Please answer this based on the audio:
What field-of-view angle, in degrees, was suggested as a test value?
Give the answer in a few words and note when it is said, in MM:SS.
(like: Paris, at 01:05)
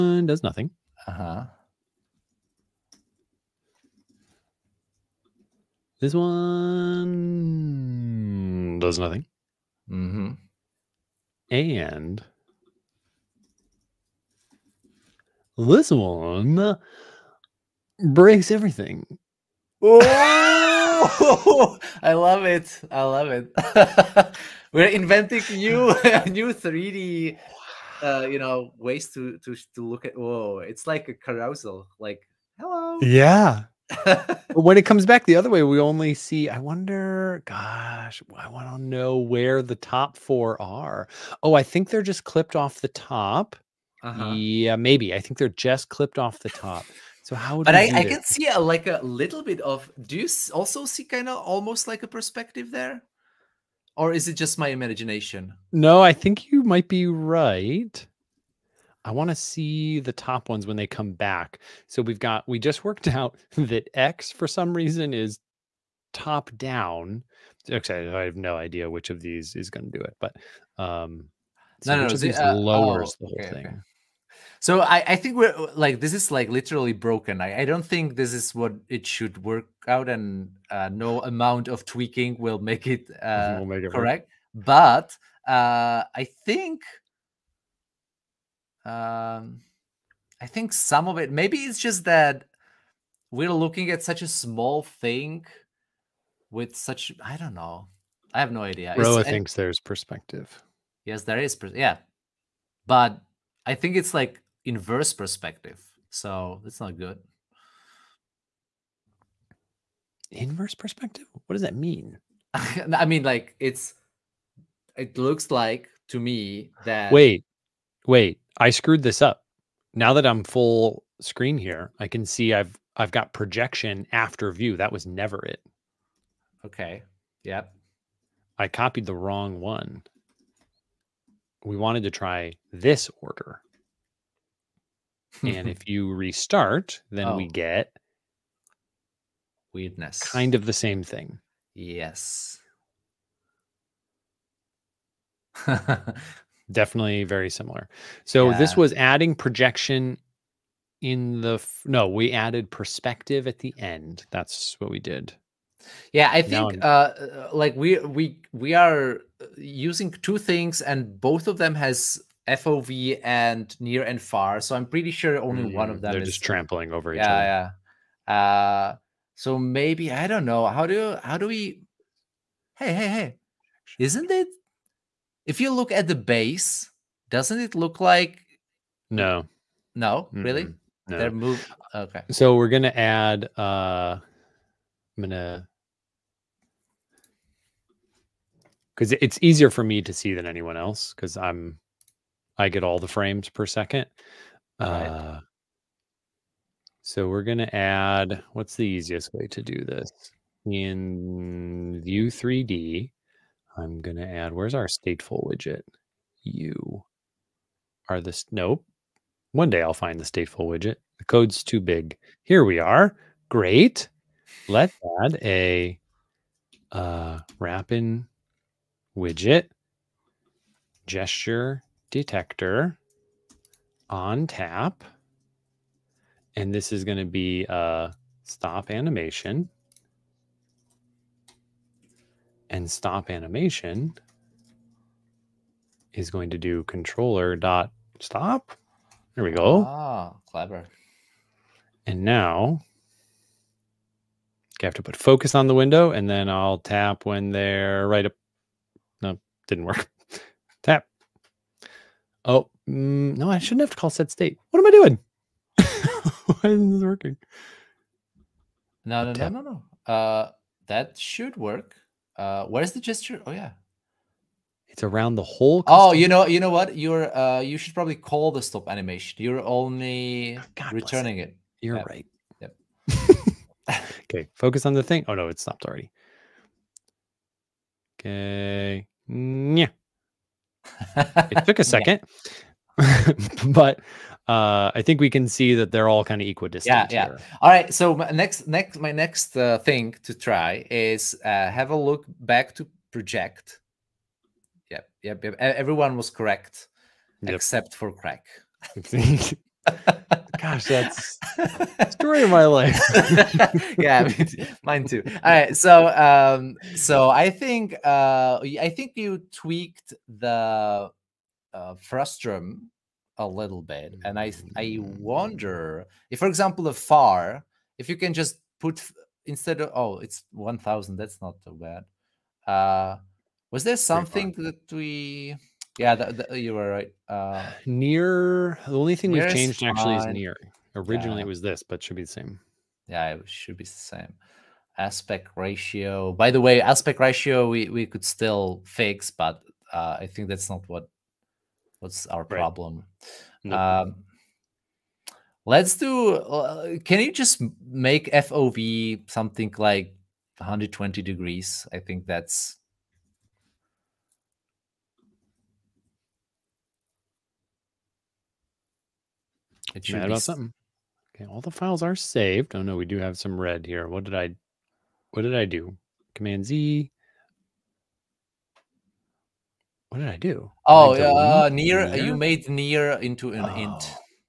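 120, at 05:50.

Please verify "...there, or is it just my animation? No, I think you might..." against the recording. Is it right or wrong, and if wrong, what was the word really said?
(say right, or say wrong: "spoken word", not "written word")
wrong: "imagination", not "animation".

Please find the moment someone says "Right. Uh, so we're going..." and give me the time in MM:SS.
03:14.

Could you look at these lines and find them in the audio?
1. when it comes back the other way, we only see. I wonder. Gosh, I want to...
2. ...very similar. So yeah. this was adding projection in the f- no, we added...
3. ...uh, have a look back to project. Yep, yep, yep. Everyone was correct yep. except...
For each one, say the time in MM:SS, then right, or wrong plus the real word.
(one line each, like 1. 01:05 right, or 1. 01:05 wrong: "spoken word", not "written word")
1. 00:34 right
2. 02:27 right
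3. 04:51 right.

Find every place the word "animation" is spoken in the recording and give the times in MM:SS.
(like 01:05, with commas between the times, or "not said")
03:48, 03:53, 04:28.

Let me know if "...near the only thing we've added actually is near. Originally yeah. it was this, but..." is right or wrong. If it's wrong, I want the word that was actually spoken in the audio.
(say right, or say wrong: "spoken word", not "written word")
wrong: "changed", not "added".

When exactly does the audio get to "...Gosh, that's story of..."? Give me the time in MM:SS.
05:00.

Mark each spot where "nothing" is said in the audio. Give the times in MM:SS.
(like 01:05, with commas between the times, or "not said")
00:00, 00:08.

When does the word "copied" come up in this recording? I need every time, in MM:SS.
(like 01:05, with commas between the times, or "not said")
02:08.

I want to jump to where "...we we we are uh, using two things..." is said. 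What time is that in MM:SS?
02:37.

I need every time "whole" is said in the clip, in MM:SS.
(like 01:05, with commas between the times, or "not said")
01:13, 04:25.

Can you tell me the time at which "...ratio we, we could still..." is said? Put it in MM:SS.
05:37.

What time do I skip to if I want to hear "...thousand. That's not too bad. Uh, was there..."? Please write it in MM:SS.
05:20.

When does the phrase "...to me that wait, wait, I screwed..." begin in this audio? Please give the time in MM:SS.
01:56.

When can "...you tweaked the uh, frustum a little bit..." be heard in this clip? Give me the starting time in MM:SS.
05:09.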